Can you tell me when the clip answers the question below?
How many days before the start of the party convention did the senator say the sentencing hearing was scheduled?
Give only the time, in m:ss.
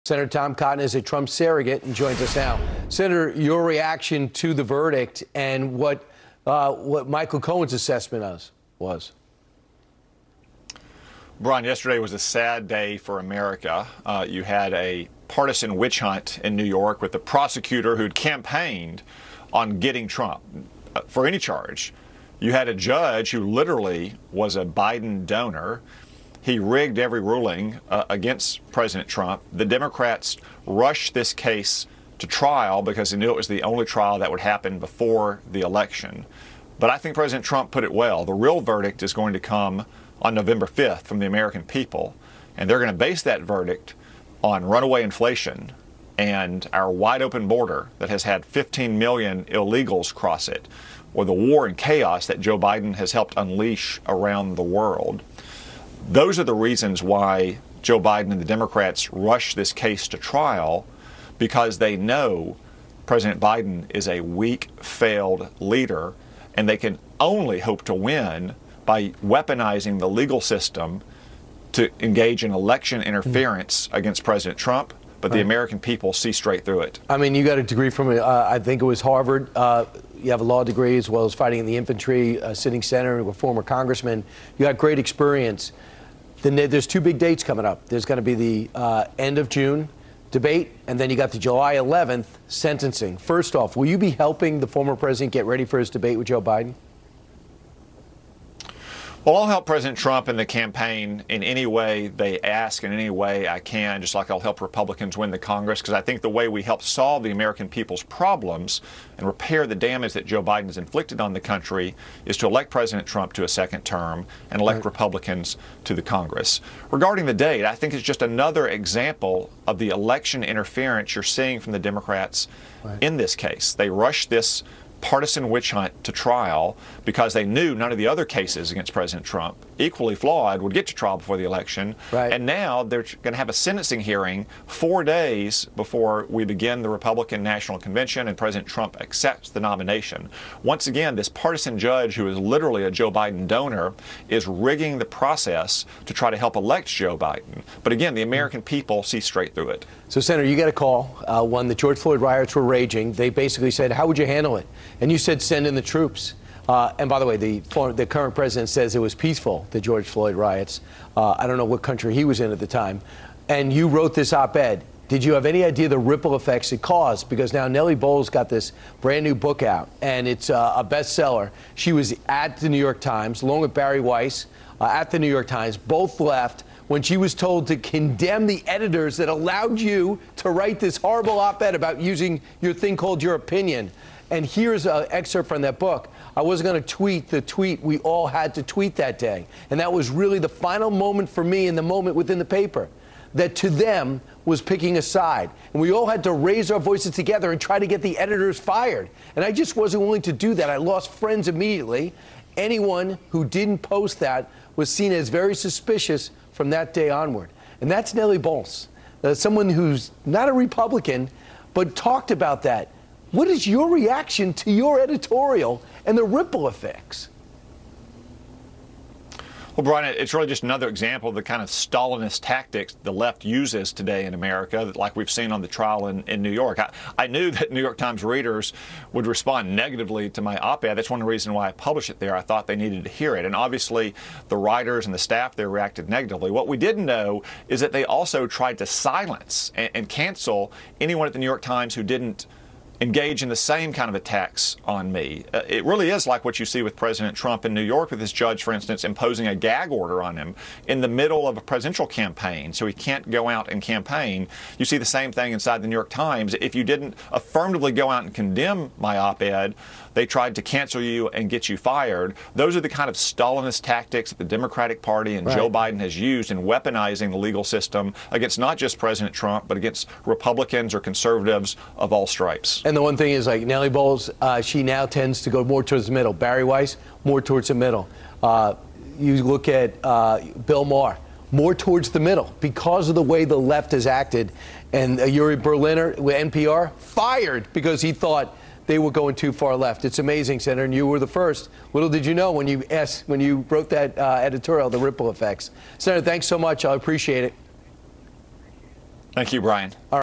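2:14.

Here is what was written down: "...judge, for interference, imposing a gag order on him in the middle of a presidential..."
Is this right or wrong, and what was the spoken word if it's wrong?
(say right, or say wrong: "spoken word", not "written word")
wrong: "instance", not "interference".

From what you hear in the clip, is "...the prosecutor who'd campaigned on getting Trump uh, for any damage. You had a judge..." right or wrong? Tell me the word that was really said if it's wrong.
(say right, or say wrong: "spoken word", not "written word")
wrong: "charge", not "damage".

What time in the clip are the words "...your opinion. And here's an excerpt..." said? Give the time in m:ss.
3:03.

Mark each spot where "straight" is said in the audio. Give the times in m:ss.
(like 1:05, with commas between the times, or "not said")
1:16, 2:29.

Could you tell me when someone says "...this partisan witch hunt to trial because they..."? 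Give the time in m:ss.
2:04.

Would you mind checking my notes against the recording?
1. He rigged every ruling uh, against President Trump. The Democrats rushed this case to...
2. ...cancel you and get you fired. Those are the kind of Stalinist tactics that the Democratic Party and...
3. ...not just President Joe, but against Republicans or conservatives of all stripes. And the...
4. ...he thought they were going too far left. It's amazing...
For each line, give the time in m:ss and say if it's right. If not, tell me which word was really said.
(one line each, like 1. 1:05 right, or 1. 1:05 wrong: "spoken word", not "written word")
1. 0:26 right
2. 4:20 right
3. 4:28 wrong: "Trump", not "Joe"
4. 4:48 right.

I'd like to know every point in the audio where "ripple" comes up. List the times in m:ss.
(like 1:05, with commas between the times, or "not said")
2:45, 3:36, 4:54.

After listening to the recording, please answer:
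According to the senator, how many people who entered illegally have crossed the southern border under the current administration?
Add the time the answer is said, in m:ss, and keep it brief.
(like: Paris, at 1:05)
15 million, at 0:48.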